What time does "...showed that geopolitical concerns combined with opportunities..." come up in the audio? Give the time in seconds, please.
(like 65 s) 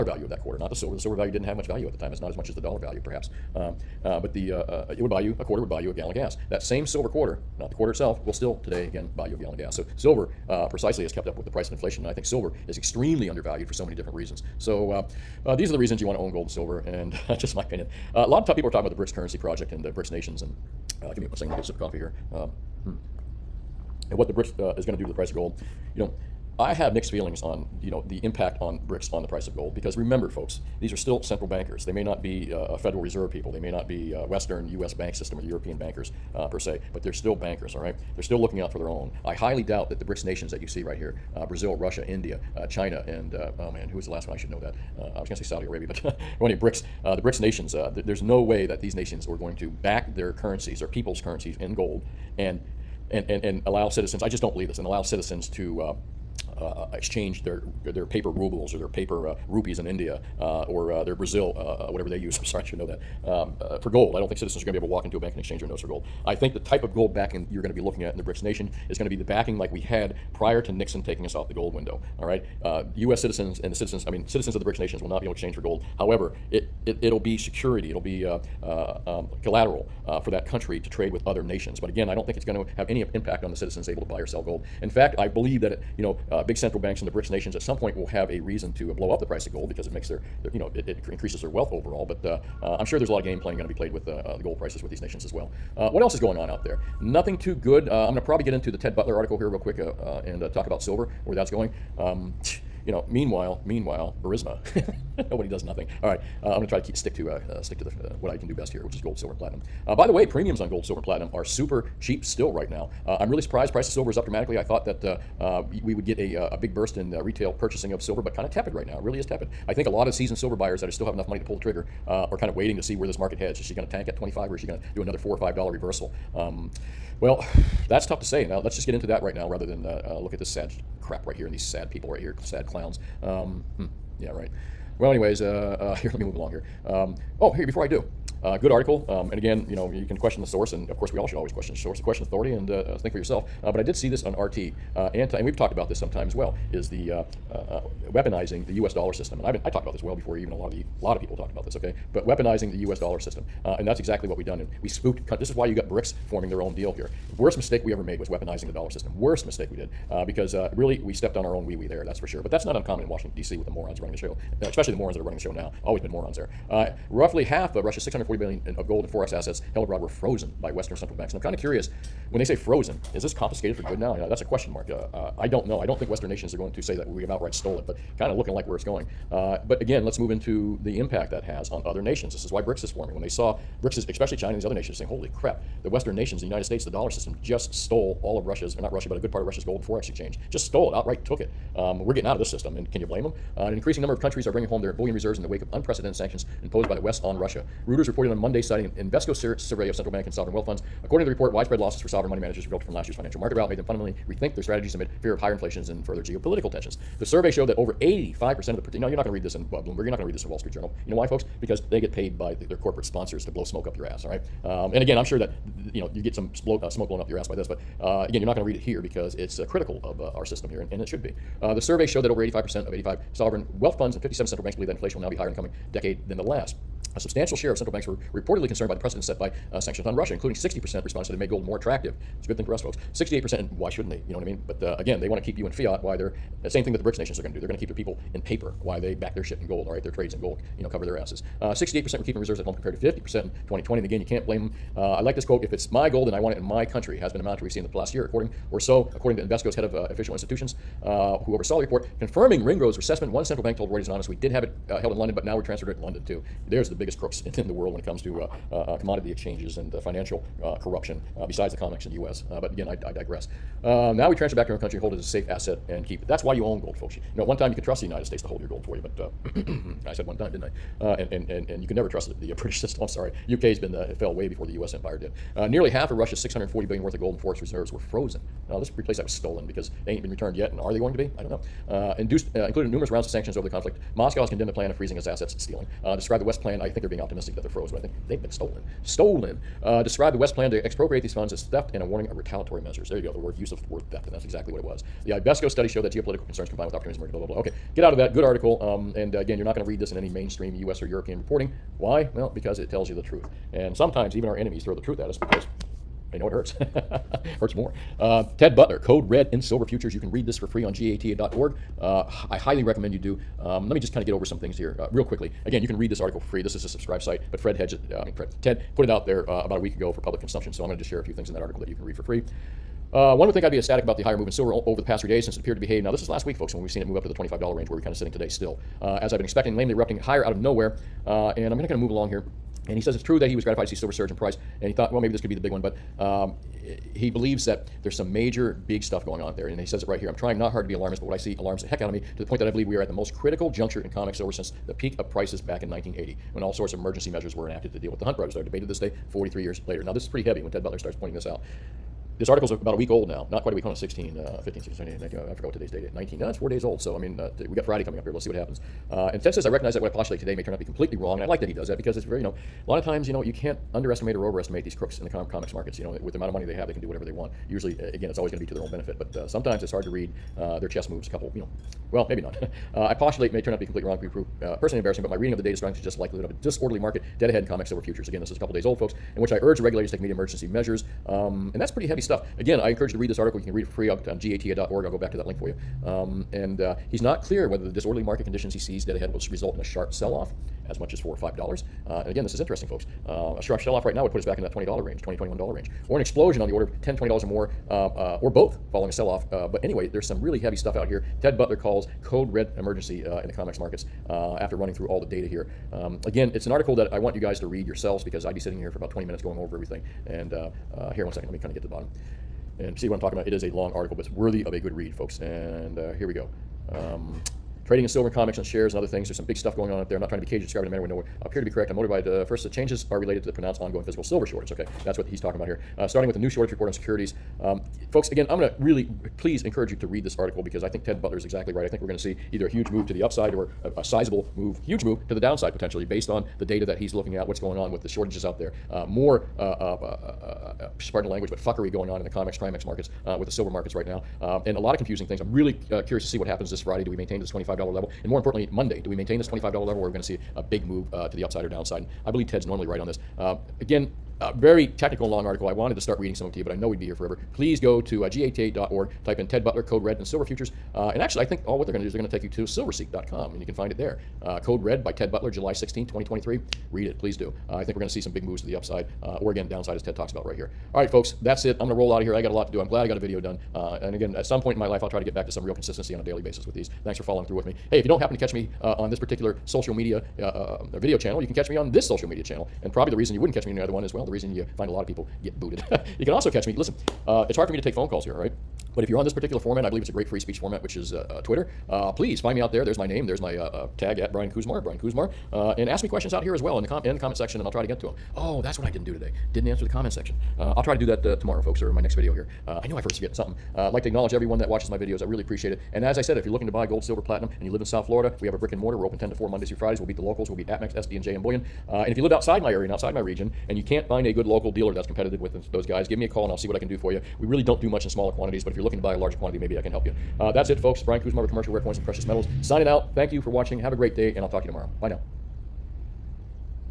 295 s.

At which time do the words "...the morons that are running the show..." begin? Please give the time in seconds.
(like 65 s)
164 s.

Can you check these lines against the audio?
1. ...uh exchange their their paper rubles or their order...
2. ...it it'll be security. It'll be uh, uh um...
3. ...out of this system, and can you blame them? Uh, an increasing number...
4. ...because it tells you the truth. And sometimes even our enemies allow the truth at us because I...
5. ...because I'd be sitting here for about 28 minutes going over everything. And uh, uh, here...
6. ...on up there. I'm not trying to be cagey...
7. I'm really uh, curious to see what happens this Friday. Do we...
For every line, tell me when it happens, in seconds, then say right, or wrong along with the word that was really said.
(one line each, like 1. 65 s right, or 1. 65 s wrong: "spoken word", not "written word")
1. 56 s wrong: "paper", not "order"
2. 76 s right
3. 192 s right
4. 302 s wrong: "throw", not "allow"
5. 408 s wrong: "20", not "28"
6. 419 s right
7. 445 s right.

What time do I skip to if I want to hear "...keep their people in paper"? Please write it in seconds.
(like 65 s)
237 s.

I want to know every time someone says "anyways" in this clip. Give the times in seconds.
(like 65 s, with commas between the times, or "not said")
135 s, 399 s.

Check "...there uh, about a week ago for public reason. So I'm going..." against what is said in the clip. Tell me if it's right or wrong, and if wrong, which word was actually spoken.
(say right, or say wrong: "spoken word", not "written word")
wrong: "consumption", not "reason".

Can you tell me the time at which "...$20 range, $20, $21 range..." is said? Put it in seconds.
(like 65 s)
394 s.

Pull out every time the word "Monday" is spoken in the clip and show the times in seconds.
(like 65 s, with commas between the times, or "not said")
198 s, 448 s, 509 s.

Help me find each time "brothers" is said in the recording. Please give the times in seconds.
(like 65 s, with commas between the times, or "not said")
348 s.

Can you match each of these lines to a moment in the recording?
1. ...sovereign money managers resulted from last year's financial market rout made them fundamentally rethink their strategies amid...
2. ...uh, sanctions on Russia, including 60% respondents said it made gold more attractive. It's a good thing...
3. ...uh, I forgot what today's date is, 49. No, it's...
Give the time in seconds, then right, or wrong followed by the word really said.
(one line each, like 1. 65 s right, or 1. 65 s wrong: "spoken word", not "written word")
1. 202 s right
2. 229 s right
3. 355 s wrong: "19", not "49".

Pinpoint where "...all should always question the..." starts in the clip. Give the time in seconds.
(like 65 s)
141 s.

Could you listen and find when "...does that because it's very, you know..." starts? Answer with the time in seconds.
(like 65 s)
361 s.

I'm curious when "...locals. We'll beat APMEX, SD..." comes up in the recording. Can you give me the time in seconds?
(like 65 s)
510 s.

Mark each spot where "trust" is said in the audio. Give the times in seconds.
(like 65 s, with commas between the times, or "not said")
267 s, 272 s.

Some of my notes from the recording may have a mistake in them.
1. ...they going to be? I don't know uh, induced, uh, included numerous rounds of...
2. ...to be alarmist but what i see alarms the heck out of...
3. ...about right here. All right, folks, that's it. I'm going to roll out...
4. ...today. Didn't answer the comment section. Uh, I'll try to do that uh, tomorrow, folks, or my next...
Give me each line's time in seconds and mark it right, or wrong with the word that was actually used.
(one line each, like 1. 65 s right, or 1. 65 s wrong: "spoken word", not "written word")
1. 280 s right
2. 340 s right
3. 470 s right
4. 499 s right.